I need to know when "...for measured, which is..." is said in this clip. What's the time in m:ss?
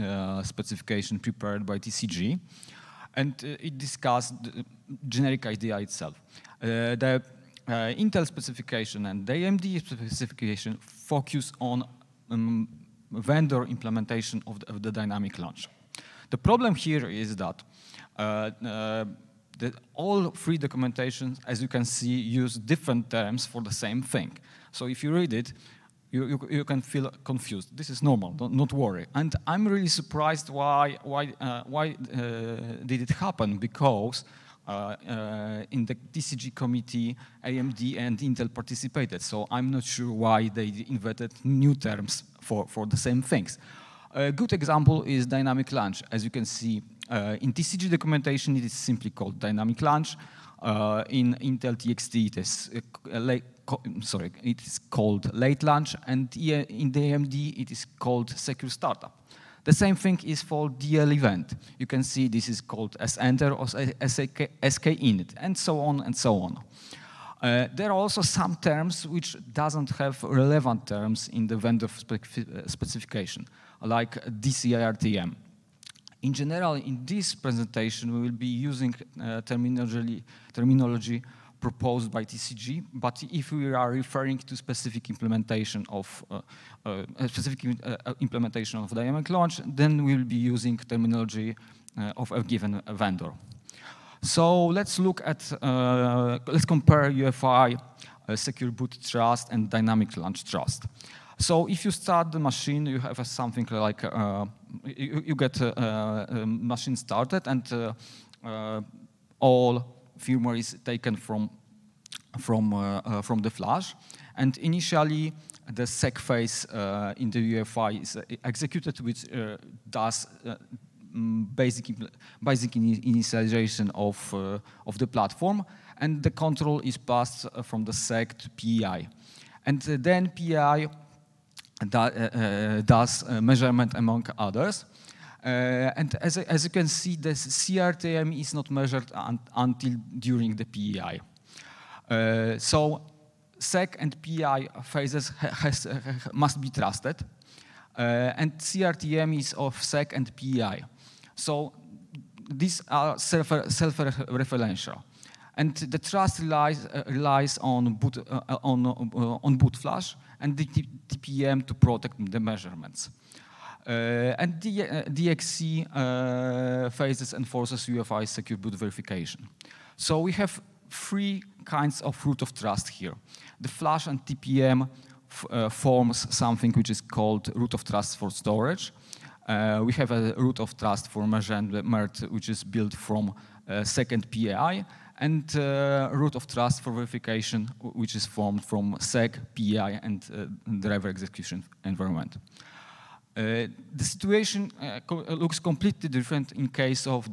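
3:01.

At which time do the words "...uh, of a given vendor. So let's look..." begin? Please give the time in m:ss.
1:31.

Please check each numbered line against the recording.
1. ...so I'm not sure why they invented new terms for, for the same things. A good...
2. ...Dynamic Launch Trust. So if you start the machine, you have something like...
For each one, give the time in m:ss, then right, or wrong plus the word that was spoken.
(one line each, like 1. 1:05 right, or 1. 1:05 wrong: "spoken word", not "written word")
1. 0:39 right
2. 1:39 right.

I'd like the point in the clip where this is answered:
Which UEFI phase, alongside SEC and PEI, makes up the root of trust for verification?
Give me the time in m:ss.
3:10.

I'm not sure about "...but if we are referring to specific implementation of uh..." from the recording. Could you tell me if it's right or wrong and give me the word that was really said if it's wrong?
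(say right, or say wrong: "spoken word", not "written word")
right.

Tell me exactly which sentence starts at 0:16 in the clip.
The problem here is that uh, uh, all three documentations, as you can see, use different terms for the same thing.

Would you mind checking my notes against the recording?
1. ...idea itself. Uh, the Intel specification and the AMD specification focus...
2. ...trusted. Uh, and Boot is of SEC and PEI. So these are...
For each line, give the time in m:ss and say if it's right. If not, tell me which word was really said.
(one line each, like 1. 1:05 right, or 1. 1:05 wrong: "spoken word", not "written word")
1. 0:05 right
2. 2:26 wrong: "CRTM", not "Boot".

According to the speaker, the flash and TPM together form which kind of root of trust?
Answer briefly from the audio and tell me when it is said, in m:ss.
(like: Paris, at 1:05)
Root of trust for storage, at 2:57.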